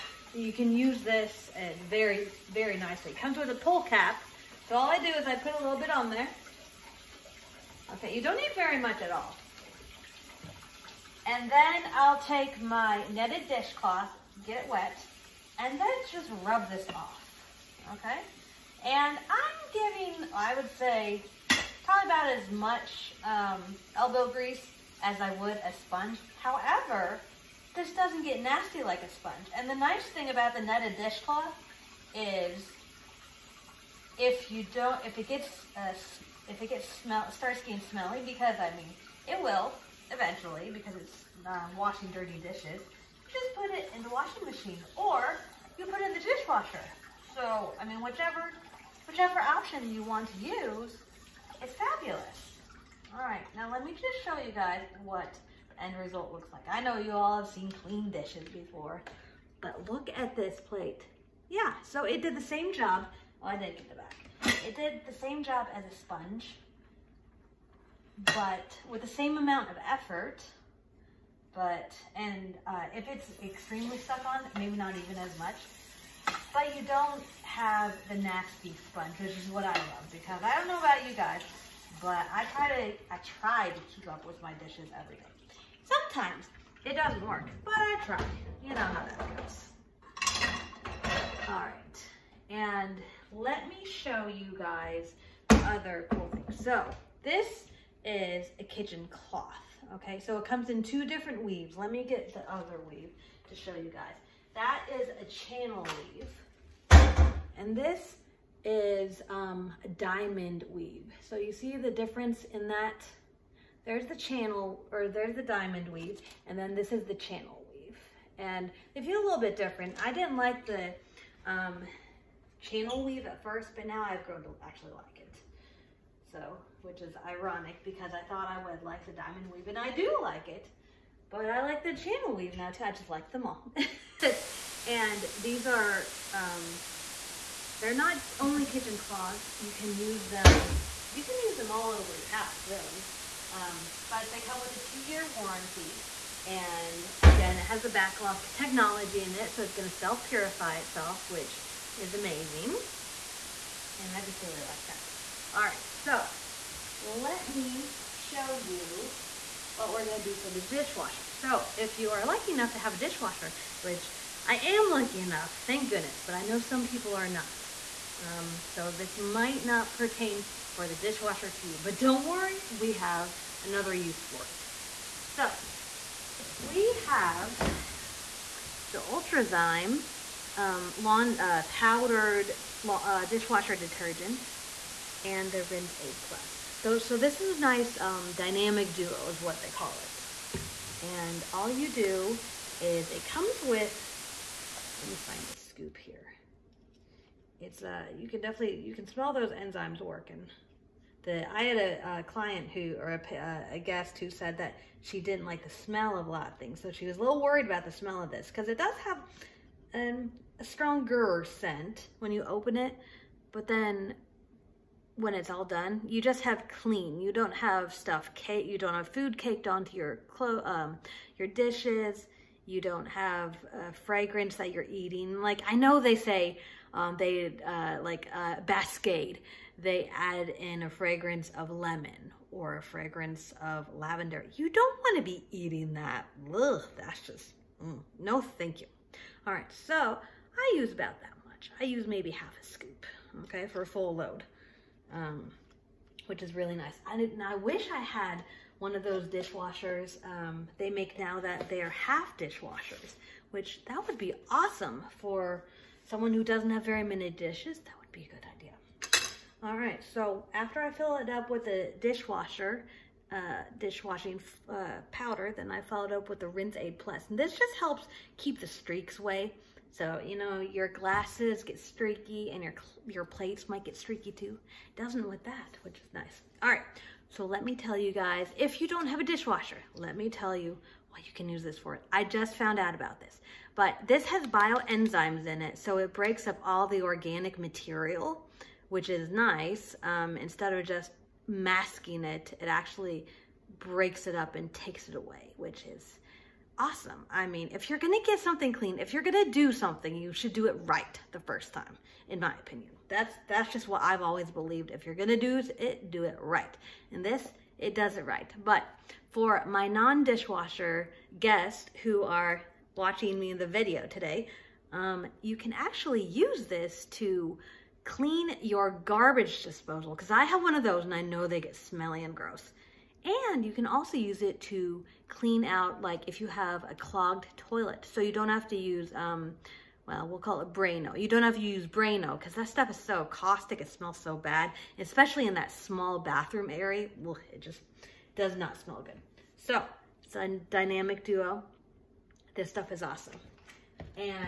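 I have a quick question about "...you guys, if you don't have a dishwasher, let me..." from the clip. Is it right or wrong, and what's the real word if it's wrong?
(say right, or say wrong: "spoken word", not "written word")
right.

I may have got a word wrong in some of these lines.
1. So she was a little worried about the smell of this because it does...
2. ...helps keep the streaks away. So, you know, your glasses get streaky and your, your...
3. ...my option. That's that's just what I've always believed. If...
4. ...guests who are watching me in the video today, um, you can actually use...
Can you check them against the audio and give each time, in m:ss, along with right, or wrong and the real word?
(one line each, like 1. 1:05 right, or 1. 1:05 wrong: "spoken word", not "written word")
1. 3:26 right
2. 4:27 right
3. 5:02 wrong: "opinion", not "option"
4. 5:11 right.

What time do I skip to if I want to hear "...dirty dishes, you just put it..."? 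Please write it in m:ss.
0:42.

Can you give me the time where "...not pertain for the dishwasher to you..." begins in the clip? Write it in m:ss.
2:49.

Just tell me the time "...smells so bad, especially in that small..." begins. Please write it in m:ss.
5:33.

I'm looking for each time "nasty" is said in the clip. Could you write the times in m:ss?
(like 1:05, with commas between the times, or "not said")
0:28, 1:18.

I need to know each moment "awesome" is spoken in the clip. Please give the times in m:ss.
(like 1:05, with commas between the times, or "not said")
4:14, 4:56, 5:43.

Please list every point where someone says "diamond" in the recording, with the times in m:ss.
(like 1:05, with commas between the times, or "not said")
1:49, 1:55, 2:09.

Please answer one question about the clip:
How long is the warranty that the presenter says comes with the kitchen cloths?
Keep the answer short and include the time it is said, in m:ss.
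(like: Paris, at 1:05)
2 years, at 2:24.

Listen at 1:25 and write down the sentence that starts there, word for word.
Sometimes it doesn't work, but I try.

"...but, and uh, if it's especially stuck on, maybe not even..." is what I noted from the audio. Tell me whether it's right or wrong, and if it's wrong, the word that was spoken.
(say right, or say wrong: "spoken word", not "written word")
wrong: "extremely", not "especially".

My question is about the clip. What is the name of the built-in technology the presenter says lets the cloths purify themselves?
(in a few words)
BacLock.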